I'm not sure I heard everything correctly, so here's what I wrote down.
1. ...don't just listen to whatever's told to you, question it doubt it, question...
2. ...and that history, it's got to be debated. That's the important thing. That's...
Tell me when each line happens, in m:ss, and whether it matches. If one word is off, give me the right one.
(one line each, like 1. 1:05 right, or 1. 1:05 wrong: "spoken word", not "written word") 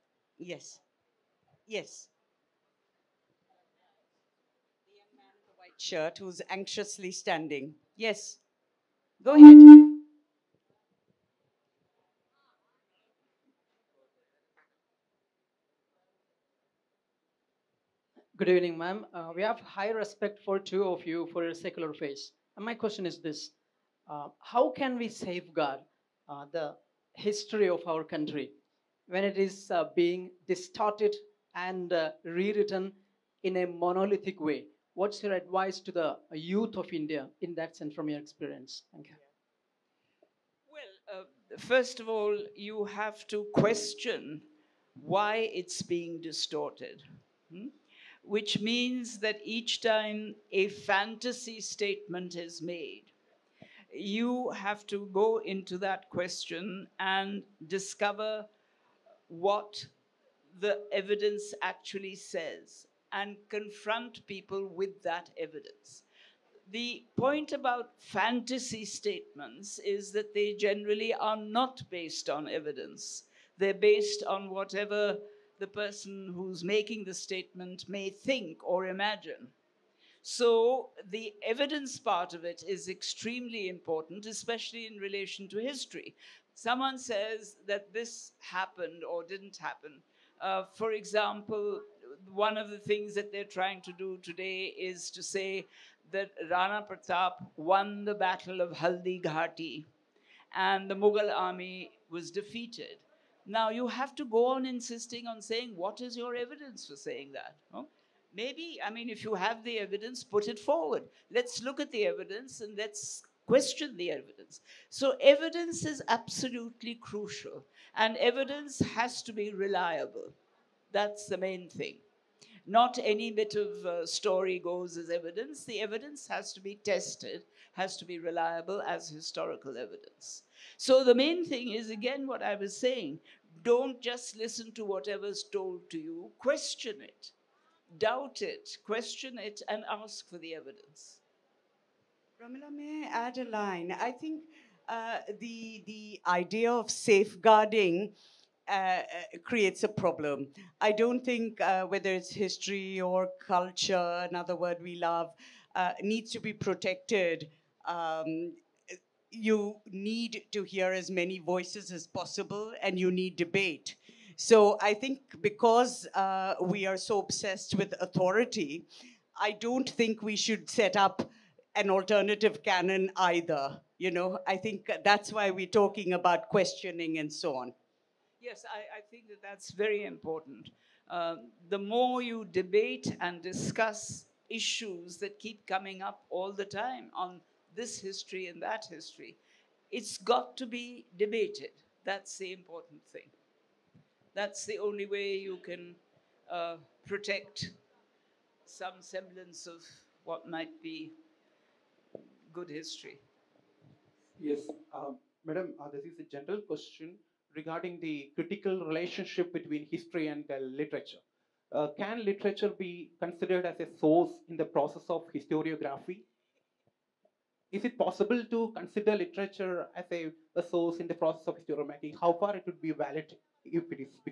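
1. 2:13 right
2. 3:08 right.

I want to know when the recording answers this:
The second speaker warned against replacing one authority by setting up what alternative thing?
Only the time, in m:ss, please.
2:51.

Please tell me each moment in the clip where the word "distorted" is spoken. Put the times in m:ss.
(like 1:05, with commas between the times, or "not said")
0:30, 0:46.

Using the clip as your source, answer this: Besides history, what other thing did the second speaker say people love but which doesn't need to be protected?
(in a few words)
Culture.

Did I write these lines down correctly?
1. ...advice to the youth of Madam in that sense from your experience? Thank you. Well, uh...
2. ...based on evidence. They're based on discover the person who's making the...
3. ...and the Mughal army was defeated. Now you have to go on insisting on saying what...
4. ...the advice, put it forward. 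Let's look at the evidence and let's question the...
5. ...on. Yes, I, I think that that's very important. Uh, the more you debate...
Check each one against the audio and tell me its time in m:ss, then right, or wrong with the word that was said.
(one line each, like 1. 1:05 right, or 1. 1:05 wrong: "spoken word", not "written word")
1. 0:35 wrong: "India", not "Madam"
2. 1:11 wrong: "whatever", not "discover"
3. 1:40 right
4. 1:49 wrong: "evidence", not "advice"
5. 2:57 right.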